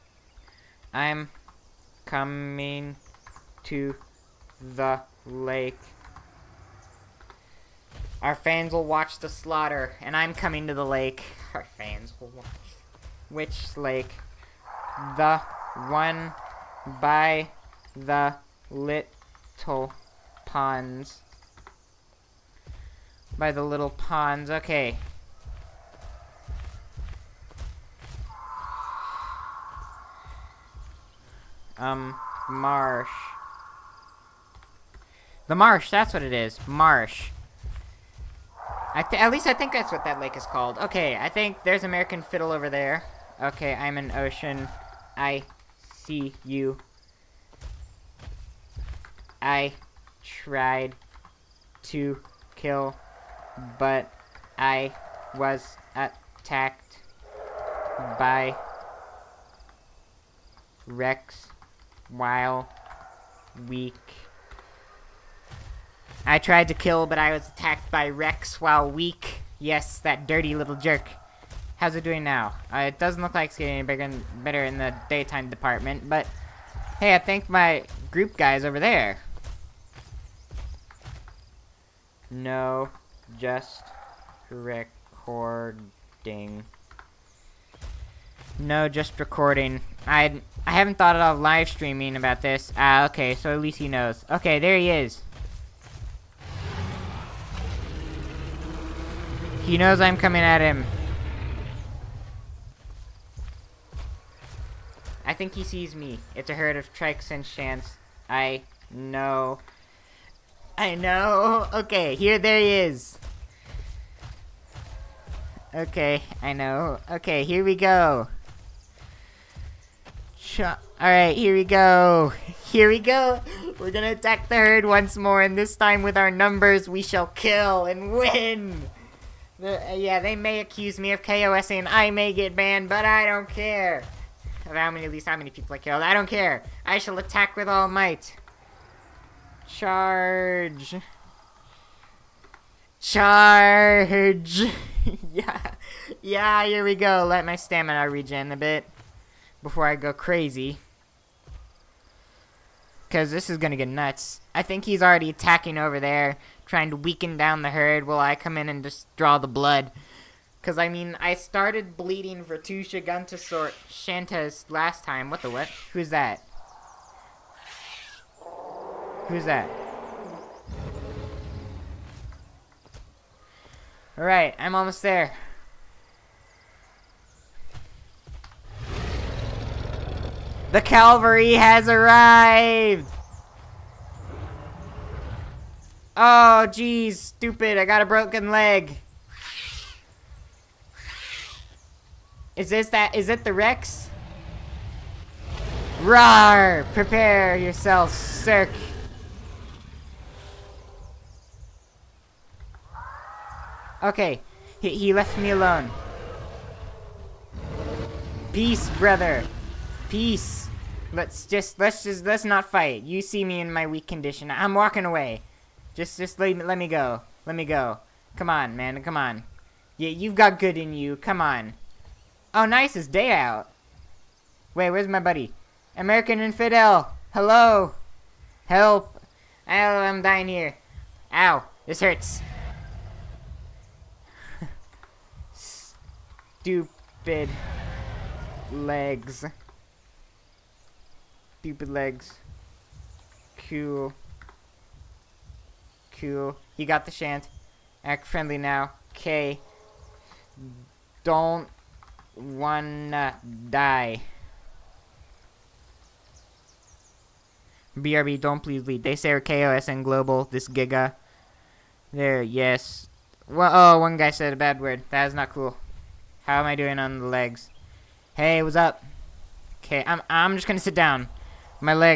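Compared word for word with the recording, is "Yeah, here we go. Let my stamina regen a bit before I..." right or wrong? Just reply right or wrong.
right.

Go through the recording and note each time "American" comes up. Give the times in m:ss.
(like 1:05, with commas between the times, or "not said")
0:41, 3:45.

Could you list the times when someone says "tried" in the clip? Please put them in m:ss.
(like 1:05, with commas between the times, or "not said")
0:50, 1:06.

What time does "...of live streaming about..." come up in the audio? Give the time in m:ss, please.
1:31.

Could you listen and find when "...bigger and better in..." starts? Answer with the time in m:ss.
1:13.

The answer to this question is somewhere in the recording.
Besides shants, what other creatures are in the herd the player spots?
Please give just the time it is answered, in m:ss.
1:46.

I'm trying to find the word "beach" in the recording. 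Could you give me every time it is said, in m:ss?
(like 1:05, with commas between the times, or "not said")
not said.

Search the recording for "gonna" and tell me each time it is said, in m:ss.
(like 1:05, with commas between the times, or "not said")
2:03, 4:30.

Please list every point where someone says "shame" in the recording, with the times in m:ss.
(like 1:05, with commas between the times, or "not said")
not said.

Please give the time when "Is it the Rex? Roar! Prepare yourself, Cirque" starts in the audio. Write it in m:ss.
3:13.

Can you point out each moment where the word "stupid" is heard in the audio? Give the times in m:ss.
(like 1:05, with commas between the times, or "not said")
3:07, 3:55, 4:01.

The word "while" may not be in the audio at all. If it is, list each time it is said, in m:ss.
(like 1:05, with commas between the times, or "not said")
1:02, 1:08, 2:38.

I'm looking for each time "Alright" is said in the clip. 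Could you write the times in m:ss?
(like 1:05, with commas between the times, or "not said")
2:00, 2:54.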